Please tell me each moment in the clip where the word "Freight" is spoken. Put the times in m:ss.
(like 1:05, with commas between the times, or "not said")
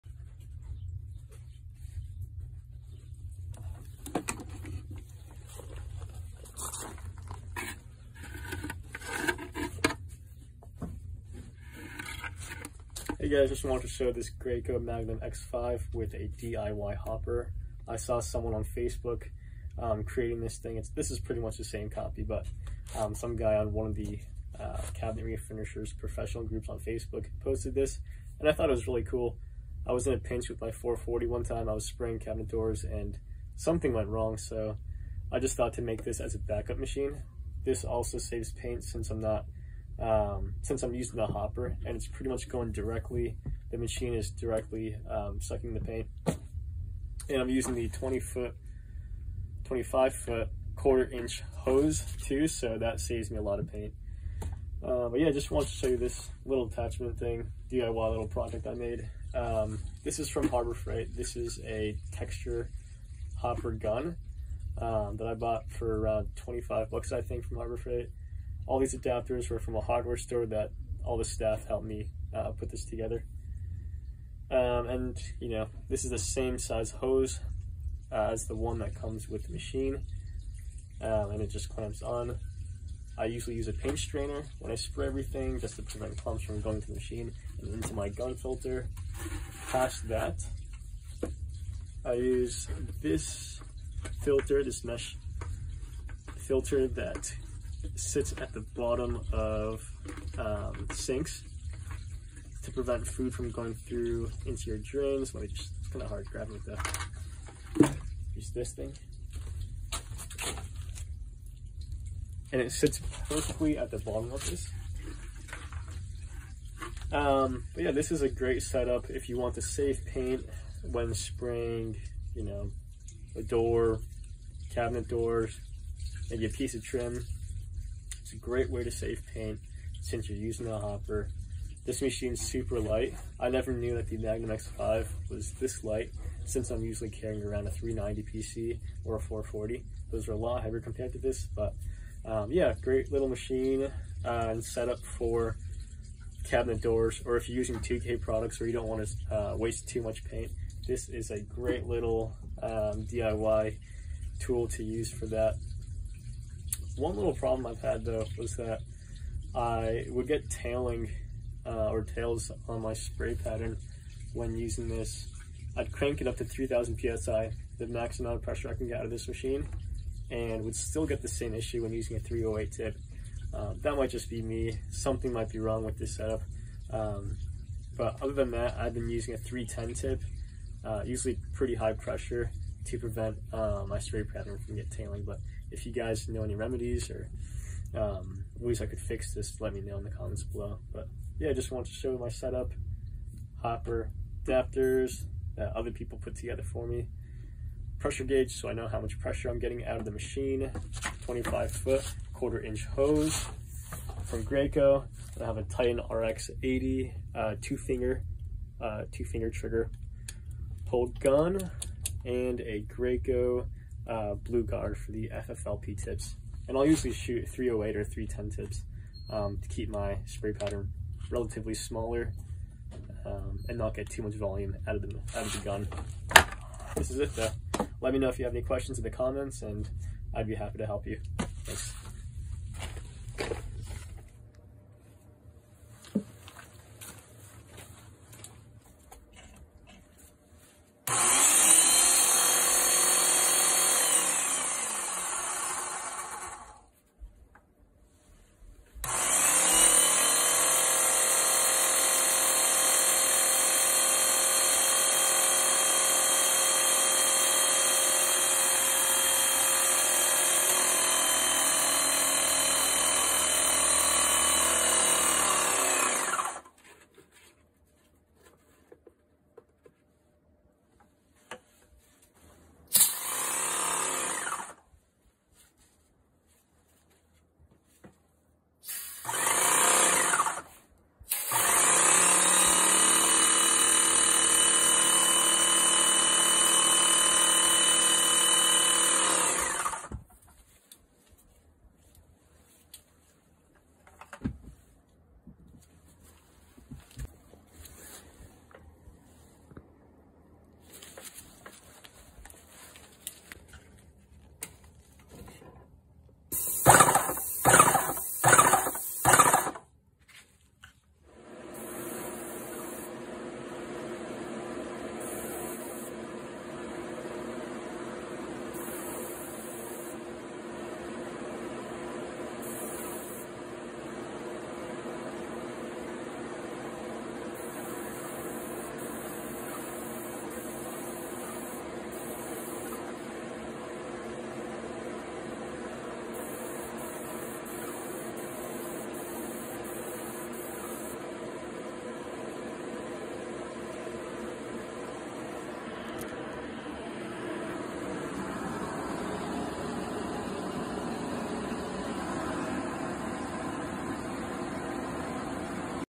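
1:00, 1:07.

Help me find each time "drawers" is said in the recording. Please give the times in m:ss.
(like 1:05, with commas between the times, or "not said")
not said.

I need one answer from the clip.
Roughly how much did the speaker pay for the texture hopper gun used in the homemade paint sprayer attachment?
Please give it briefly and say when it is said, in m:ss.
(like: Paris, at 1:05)
$25, at 1:06.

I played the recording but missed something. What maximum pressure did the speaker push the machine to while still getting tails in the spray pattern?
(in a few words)
3000 psi.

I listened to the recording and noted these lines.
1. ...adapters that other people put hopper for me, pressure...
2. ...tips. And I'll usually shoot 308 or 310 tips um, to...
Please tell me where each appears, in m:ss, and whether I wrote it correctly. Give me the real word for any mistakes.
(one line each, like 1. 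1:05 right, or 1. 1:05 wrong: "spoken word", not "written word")
1. 3:14 wrong: "together", not "hopper"
2. 3:36 right.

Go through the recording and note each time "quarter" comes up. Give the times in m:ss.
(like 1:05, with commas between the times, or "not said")
0:50, 3:22.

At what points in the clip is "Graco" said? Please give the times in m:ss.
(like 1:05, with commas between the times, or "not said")
0:14, 3:24, 3:32.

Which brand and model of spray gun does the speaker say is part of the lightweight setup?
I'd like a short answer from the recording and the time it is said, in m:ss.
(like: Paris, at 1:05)
Titan RX80, at 3:25.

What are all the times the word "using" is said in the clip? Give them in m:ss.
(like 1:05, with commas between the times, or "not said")
0:40, 0:47, 2:10, 2:27, 2:44, 2:51, 2:59.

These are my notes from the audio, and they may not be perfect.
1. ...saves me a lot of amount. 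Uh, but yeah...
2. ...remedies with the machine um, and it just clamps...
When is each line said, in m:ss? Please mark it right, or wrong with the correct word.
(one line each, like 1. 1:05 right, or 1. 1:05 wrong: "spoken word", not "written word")
1. 0:52 wrong: "paint", not "amount"
2. 1:18 wrong: "comes", not "remedies".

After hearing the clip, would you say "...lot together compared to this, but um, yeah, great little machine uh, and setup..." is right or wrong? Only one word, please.
wrong.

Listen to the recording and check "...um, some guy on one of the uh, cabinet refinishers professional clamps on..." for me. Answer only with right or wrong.
wrong.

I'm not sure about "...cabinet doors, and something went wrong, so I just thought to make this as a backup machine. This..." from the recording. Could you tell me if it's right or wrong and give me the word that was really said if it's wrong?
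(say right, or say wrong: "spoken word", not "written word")
right.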